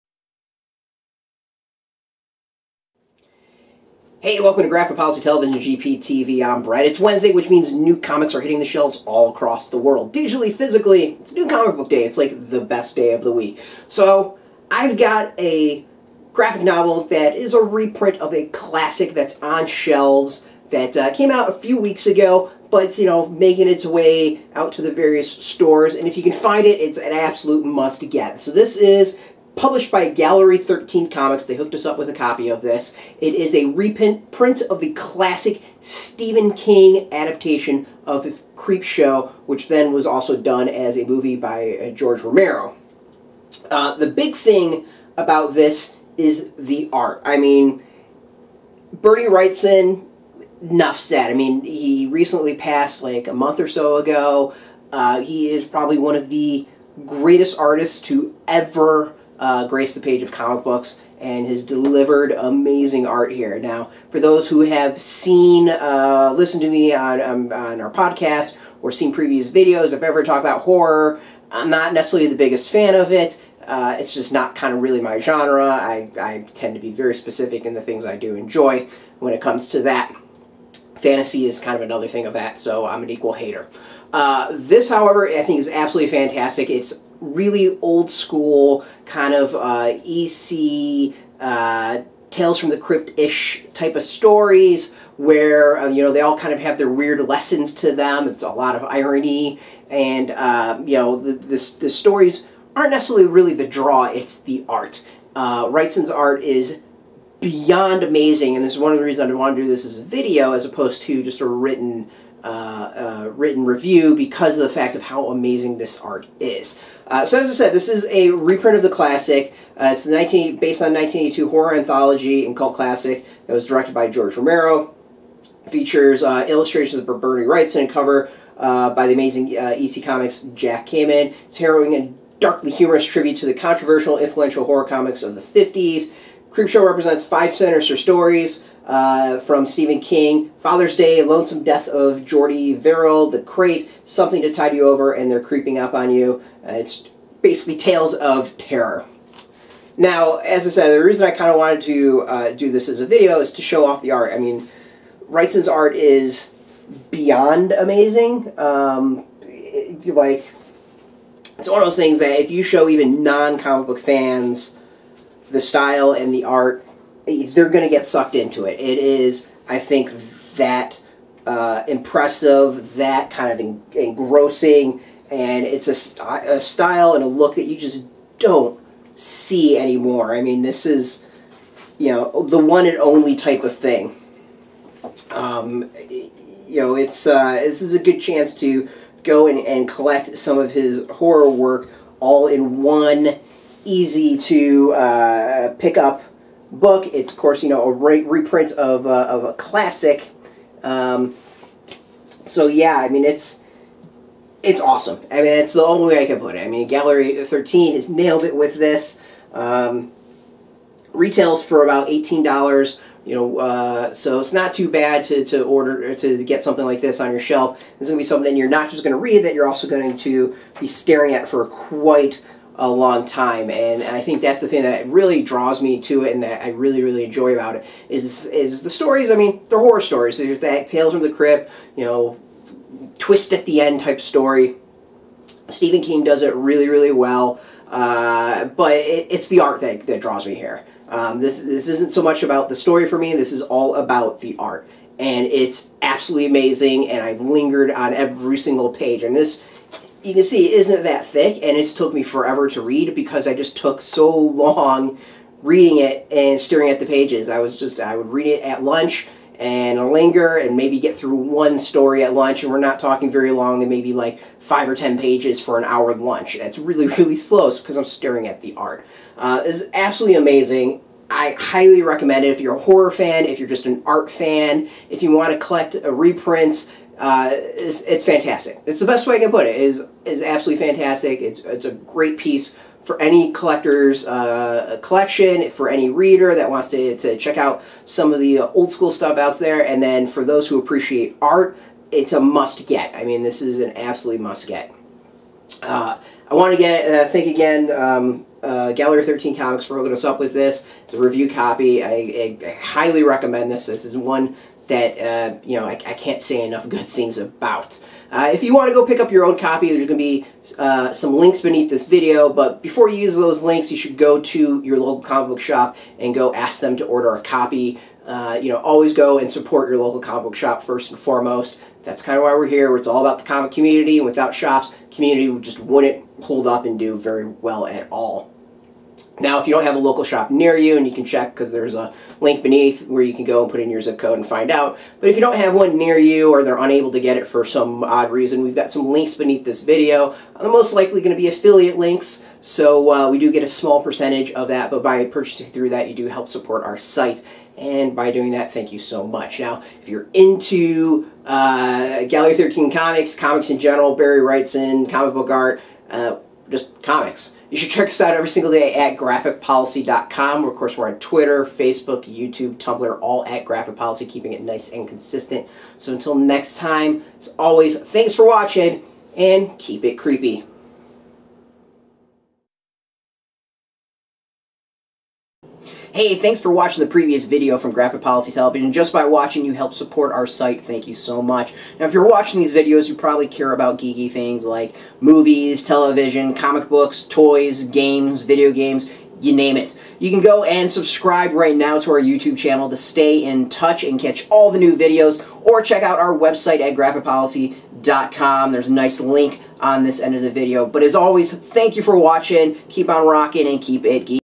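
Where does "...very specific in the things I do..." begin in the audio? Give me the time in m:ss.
1:16.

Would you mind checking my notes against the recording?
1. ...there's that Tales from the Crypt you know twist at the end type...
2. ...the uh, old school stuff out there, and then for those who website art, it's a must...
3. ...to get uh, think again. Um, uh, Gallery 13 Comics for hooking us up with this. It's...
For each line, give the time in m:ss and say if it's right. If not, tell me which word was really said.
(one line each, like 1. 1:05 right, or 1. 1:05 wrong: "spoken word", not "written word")
1. 3:50 right
2. 4:48 wrong: "appreciate", not "website"
3. 4:56 right.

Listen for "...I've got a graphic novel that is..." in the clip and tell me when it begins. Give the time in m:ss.
0:14.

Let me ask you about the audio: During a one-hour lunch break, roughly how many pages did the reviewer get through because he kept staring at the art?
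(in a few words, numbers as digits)
5 or 10 pages.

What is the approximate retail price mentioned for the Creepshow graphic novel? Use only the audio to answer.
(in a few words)
$18.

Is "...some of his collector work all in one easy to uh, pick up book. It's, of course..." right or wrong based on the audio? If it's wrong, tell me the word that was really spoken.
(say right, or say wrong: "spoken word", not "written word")
wrong: "horror", not "collector".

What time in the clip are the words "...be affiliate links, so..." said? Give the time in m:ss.
5:41.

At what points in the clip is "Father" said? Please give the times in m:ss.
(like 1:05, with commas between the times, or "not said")
2:20.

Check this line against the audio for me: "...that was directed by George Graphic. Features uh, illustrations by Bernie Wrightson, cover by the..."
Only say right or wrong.
wrong.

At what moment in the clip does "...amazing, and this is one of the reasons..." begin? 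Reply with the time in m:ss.
1:48.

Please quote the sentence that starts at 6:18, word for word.
Just by watching, you help support our site.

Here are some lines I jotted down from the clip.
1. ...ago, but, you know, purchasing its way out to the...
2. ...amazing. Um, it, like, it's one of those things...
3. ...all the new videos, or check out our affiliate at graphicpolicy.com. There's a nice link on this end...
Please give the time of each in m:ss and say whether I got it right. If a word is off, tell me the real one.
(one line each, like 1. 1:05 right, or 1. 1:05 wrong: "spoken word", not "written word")
1. 0:22 wrong: "making", not "purchasing"
2. 2:37 right
3. 6:34 wrong: "website", not "affiliate".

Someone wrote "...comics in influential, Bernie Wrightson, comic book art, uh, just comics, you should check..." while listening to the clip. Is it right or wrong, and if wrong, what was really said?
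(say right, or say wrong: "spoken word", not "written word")
wrong: "general", not "influential".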